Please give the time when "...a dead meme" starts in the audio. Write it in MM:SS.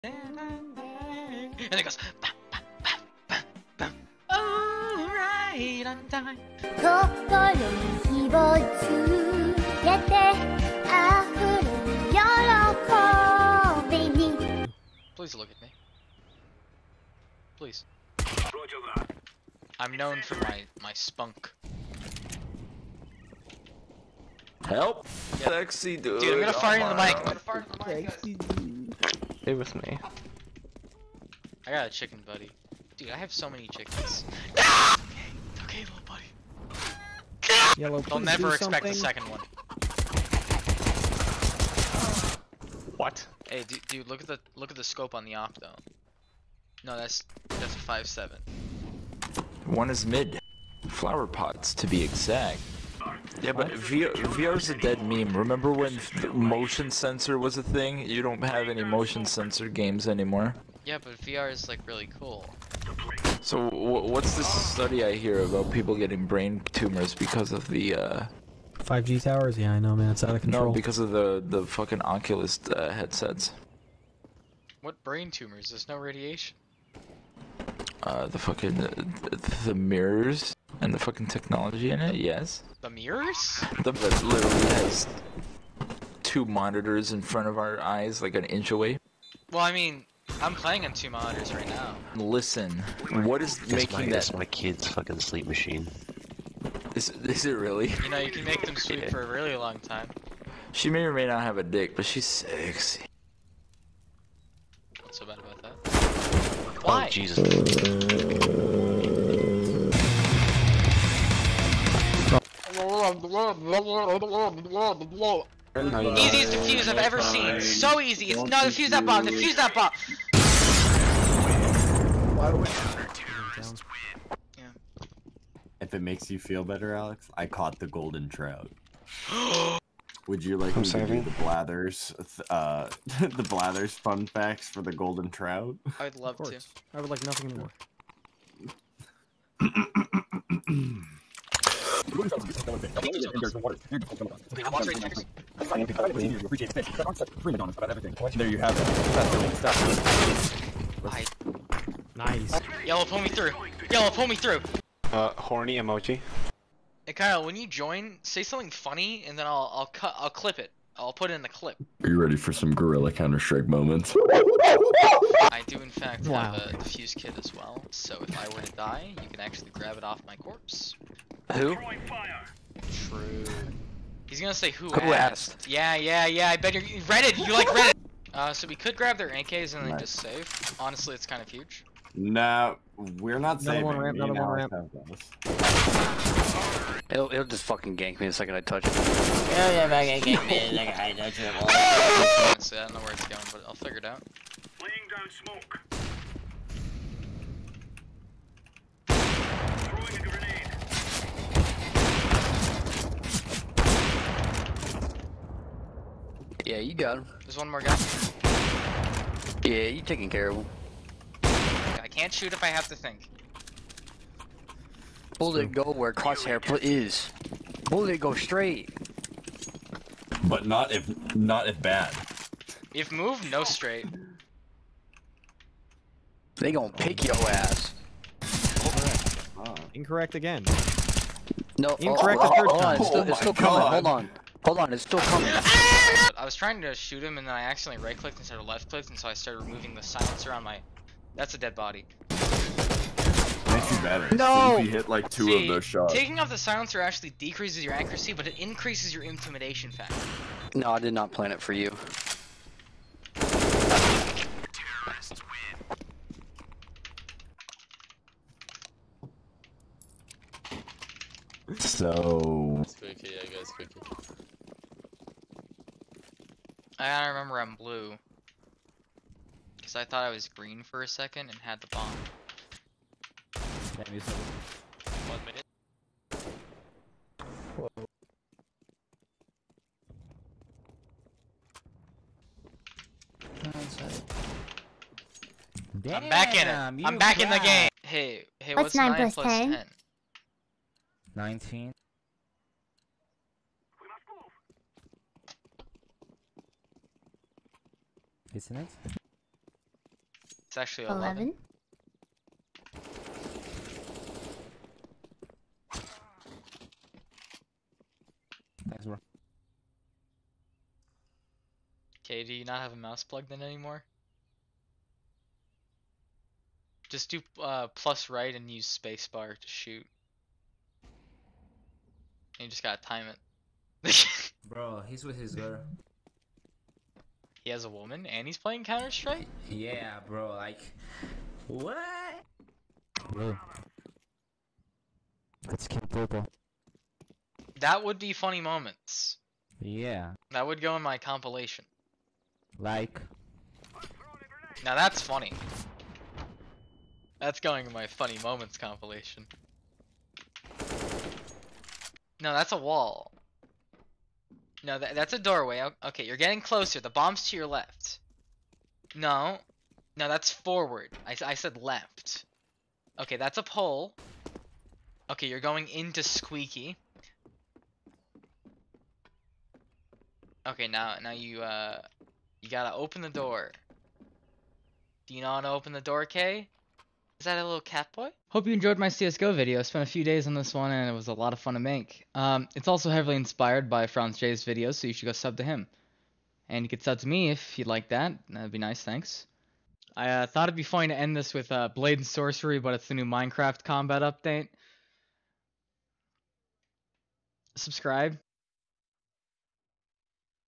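00:54.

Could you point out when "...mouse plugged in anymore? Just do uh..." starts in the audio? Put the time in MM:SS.
05:12.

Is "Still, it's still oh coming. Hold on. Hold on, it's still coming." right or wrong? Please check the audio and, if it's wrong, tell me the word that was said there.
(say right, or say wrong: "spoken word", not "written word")
right.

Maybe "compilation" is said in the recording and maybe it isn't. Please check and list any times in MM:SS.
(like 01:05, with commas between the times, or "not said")
05:41, 05:48.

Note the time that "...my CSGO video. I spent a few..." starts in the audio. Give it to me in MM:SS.
06:18.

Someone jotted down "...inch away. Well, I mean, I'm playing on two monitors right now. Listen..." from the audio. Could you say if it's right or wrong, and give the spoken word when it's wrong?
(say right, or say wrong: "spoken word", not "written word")
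right.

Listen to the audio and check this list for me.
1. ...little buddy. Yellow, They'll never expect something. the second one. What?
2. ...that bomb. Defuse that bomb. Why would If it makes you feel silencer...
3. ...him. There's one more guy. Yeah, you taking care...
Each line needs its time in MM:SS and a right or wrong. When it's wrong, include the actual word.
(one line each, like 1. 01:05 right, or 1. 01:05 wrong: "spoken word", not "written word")
1. 00:35 right
2. 01:58 wrong: "better", not "silencer"
3. 03:27 right.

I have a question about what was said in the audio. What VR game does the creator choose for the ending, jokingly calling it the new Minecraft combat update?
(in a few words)
Blade and Sorcery.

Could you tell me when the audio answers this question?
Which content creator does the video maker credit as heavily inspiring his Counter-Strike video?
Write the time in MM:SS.
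06:24.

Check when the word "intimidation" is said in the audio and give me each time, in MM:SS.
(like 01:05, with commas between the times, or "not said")
04:09.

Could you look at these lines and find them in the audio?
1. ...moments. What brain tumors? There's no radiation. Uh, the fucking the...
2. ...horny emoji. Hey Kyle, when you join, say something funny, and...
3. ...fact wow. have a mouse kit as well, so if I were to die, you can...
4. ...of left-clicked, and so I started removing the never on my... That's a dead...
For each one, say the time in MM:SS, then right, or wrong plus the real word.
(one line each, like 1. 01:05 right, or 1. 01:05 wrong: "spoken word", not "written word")
1. 01:12 wrong: "headsets", not "moments"
2. 02:35 right
3. 02:45 wrong: "defuse", not "mouse"
4. 03:58 wrong: "silencer", not "never".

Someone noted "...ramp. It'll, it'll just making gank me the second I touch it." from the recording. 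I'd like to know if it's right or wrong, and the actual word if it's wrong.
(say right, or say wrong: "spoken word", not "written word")
wrong: "fucking", not "making".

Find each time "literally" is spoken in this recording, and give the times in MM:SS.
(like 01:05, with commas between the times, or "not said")
01:24.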